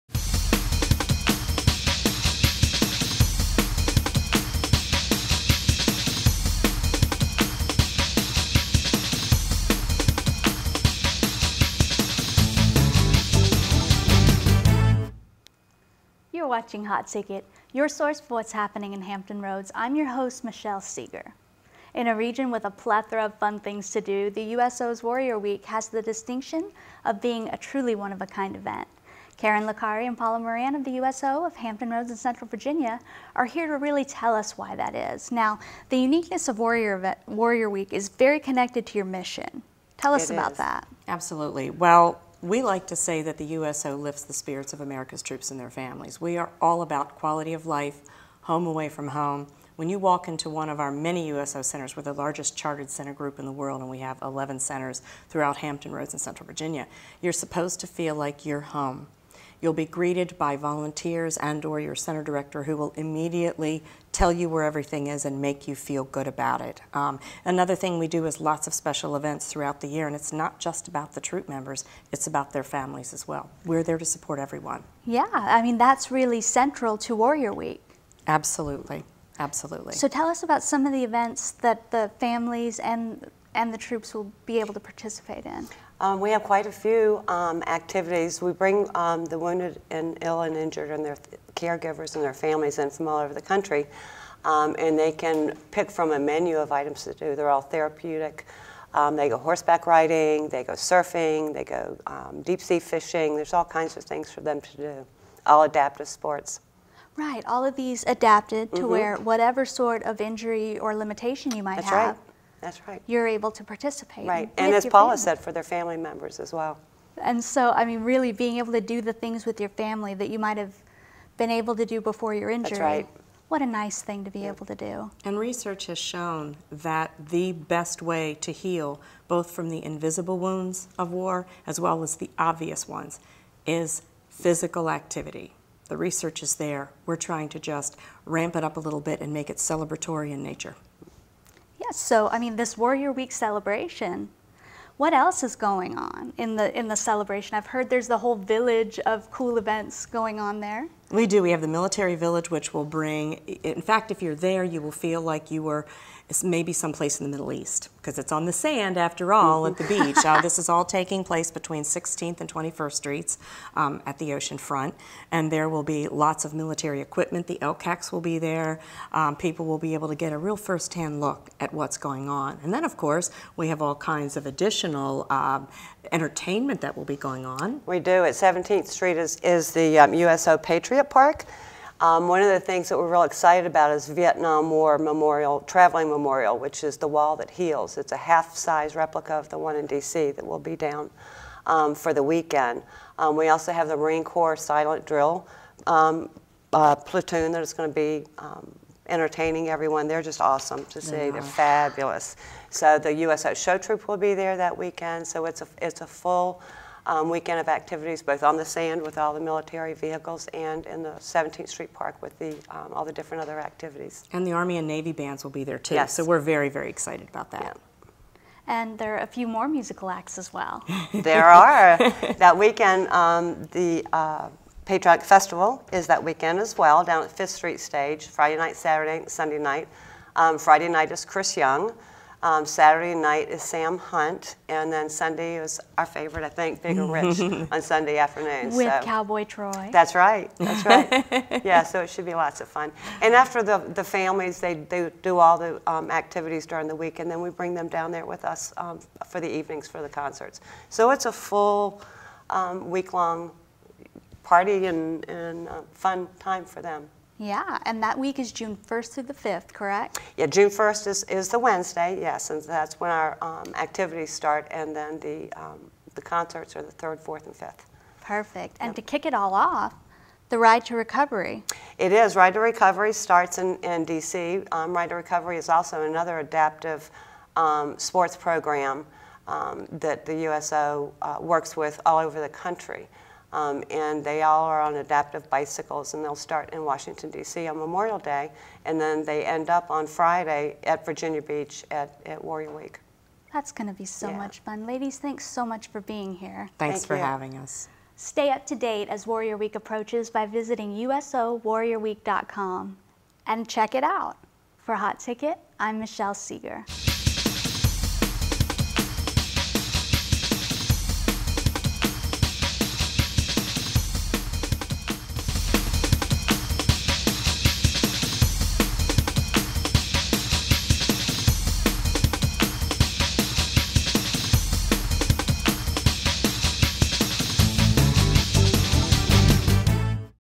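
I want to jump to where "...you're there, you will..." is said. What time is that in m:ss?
2:34.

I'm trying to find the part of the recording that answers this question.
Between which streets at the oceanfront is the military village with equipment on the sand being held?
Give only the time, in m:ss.
2:41.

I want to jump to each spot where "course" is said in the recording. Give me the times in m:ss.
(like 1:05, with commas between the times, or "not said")
2:52.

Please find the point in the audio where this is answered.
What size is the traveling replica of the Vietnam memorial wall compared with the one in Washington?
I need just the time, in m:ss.
3:08.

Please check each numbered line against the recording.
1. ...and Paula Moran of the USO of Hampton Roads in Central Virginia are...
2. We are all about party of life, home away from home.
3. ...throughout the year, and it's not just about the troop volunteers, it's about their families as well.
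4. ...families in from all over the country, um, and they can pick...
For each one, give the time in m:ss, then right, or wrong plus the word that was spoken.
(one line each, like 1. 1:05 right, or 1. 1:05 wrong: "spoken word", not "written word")
1. 0:30 right
2. 0:46 wrong: "quality", not "party"
3. 1:09 wrong: "members", not "volunteers"
4. 1:32 right.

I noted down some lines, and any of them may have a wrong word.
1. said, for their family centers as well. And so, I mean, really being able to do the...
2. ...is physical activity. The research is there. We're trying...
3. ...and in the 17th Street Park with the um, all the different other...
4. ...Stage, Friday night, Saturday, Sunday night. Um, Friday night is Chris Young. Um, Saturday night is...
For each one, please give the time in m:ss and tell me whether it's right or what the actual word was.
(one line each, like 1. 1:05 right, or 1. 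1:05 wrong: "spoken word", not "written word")
1. 1:55 wrong: "members", not "centers"
2. 2:13 right
3. 3:30 right
4. 3:47 right.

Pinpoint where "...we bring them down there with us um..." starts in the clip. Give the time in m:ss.
4:07.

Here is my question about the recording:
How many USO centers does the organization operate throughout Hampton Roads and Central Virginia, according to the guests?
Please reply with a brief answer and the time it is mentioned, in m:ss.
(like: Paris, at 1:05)
11, at 0:54.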